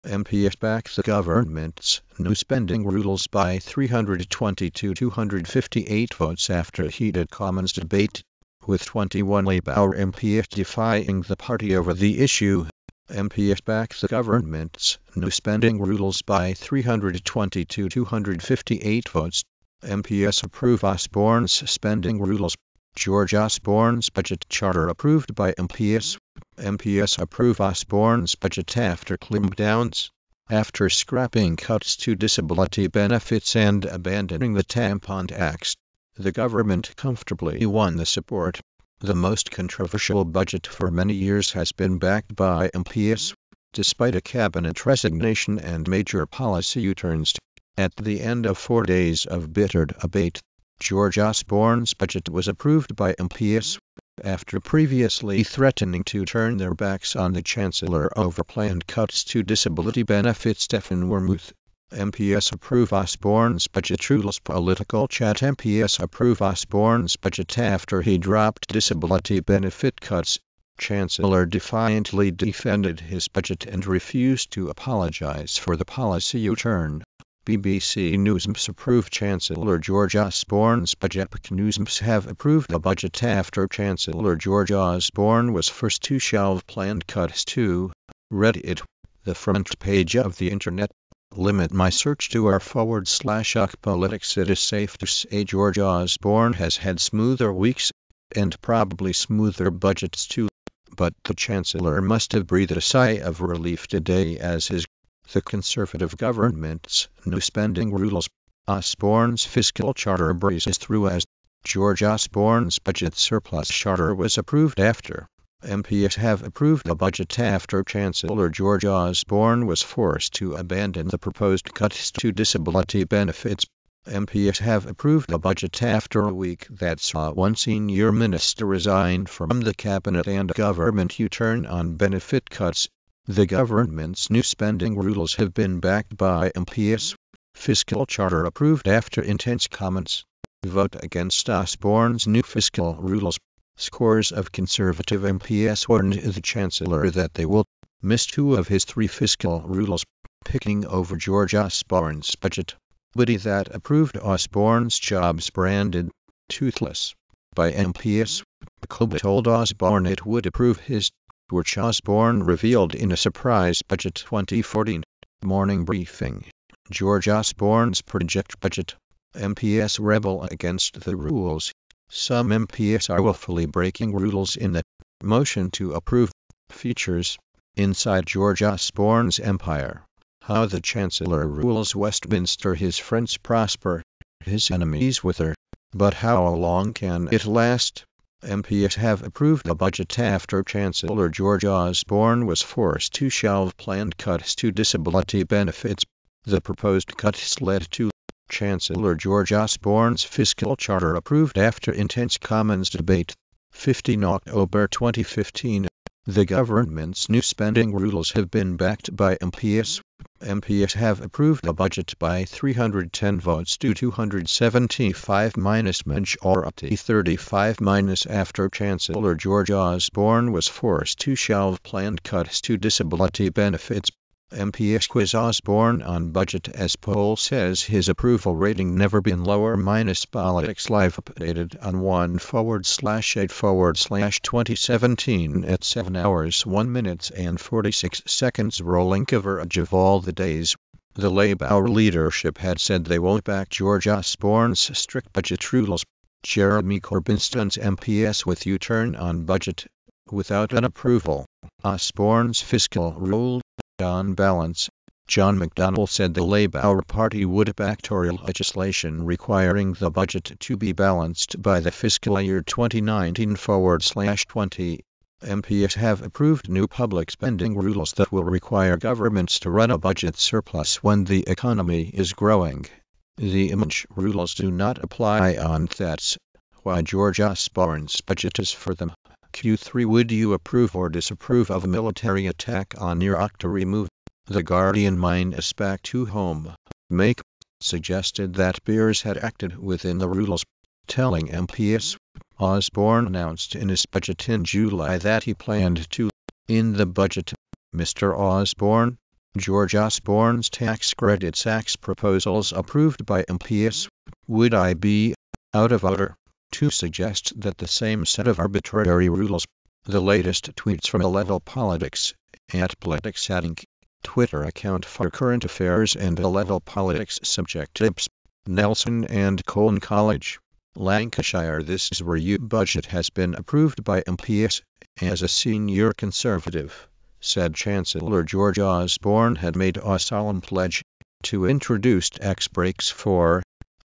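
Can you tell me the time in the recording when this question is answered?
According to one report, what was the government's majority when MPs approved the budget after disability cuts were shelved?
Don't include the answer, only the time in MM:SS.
03:36.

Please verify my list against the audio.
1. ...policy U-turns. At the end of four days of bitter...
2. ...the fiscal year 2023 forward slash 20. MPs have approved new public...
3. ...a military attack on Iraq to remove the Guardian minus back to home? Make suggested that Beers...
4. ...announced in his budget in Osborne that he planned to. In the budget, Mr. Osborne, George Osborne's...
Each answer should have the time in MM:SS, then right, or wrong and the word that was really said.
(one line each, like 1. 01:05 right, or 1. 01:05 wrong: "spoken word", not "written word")
1. 00:46 right
2. 04:21 wrong: "2019", not "2023"
3. 04:41 right
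4. 04:53 wrong: "July", not "Osborne".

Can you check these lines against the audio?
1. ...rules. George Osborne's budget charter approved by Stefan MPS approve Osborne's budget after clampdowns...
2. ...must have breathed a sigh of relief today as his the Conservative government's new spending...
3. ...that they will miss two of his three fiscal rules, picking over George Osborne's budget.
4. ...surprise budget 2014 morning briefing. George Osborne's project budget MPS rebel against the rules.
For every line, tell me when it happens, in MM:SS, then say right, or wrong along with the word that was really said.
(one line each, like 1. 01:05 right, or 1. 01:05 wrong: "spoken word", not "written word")
1. 00:22 wrong: "MPS", not "Stefan"
2. 01:42 right
3. 02:27 right
4. 02:43 right.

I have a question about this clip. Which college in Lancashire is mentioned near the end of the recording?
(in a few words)
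Nelson and Colne College.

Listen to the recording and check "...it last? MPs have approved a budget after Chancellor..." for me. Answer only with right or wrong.
right.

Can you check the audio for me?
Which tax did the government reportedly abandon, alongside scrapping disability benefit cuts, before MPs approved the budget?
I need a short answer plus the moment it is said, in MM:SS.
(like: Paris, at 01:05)
tampon tax, at 00:34.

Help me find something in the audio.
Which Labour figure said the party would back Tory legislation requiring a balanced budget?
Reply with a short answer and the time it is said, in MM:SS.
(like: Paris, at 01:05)
John McDonnell, at 04:15.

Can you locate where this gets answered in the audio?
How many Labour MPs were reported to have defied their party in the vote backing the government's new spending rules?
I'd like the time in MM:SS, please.
00:08.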